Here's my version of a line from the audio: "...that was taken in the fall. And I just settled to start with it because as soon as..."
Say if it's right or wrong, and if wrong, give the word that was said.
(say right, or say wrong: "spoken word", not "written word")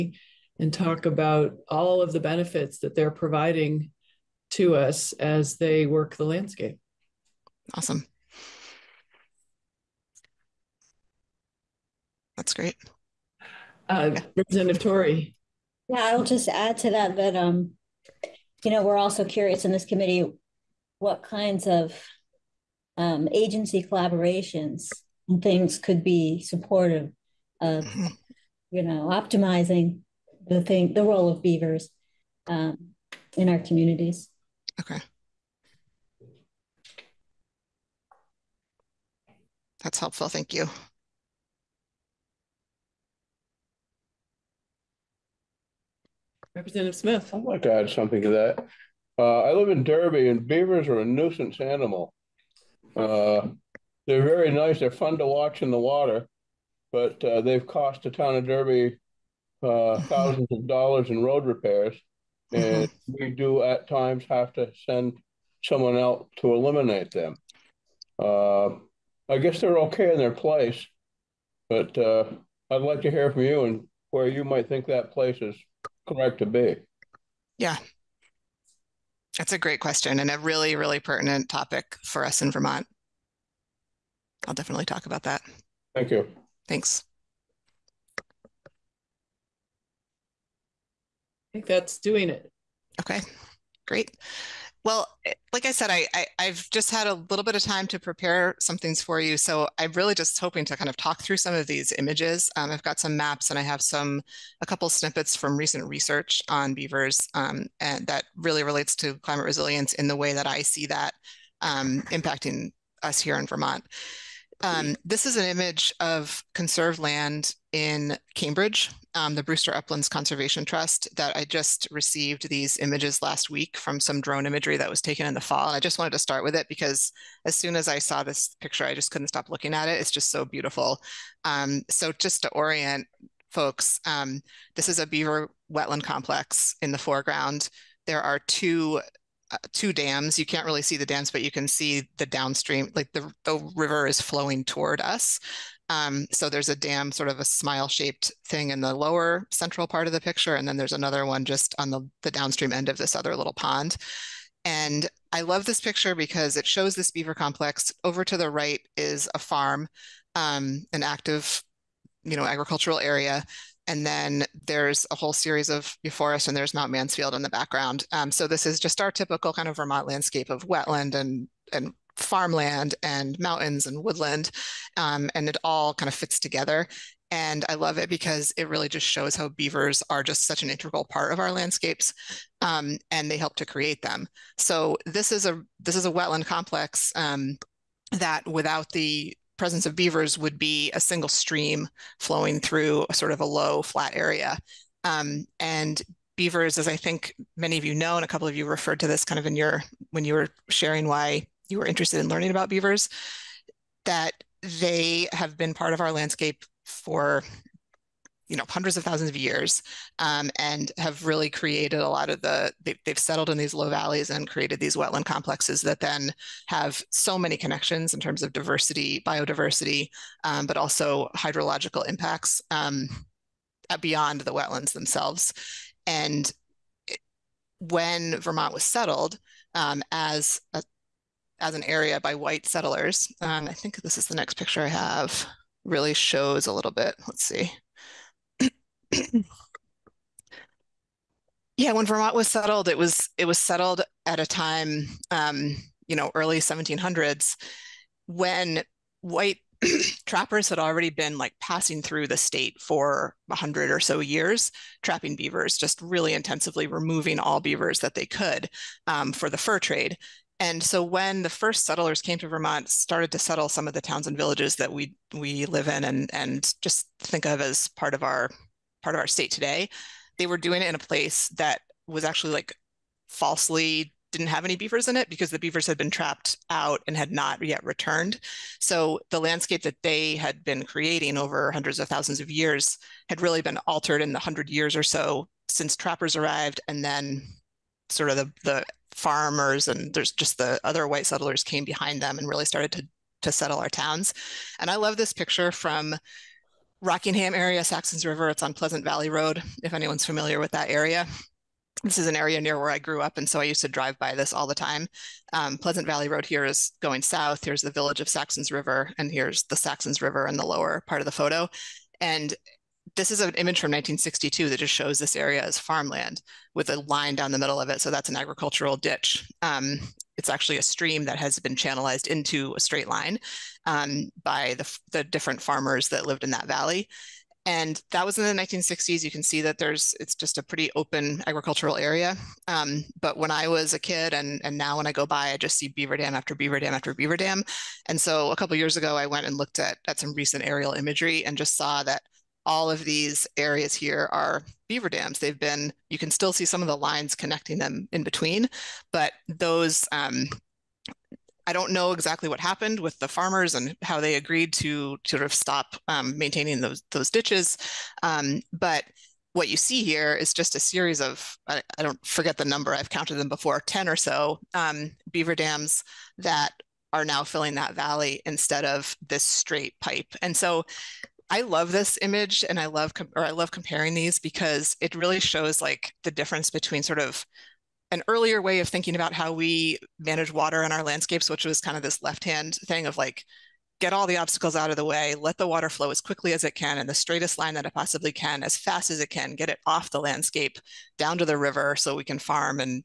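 wrong: "wanted", not "settled".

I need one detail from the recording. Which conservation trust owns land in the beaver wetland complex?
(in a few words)
Brewster Uplands Conservation Trust.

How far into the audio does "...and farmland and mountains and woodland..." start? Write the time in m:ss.
2:51.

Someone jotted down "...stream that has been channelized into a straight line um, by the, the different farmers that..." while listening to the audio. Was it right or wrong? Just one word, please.
right.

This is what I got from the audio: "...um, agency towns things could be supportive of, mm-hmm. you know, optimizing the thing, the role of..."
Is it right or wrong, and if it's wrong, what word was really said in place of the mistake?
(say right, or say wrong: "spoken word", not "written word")
wrong: "collaborations", not "towns".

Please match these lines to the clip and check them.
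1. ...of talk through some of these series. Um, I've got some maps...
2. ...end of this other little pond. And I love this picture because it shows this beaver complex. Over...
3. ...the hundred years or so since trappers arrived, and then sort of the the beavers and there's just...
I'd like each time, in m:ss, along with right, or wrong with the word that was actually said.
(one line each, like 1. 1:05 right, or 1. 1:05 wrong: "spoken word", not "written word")
1. 1:40 wrong: "images", not "series"
2. 2:32 right
3. 4:44 wrong: "farmers", not "beavers".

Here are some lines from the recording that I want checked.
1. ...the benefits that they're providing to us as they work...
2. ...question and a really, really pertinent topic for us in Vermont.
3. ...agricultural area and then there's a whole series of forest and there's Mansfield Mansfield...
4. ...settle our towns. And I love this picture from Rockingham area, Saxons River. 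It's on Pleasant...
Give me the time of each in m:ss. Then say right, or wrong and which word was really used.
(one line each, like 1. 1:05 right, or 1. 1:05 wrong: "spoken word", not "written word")
1. 0:02 right
2. 1:19 right
3. 2:42 wrong: "Mount", not "Mansfield"
4. 4:53 right.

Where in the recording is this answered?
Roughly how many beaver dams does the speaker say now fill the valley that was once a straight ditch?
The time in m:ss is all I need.
6:03.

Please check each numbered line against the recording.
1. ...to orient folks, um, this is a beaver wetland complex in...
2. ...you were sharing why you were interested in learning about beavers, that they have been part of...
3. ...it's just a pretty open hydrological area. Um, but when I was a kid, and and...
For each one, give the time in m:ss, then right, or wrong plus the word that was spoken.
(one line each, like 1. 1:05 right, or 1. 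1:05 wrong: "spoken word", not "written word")
1. 2:12 right
2. 3:20 right
3. 5:30 wrong: "agricultural", not "hydrological".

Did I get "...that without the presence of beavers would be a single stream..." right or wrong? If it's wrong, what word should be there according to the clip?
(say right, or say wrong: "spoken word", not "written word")
right.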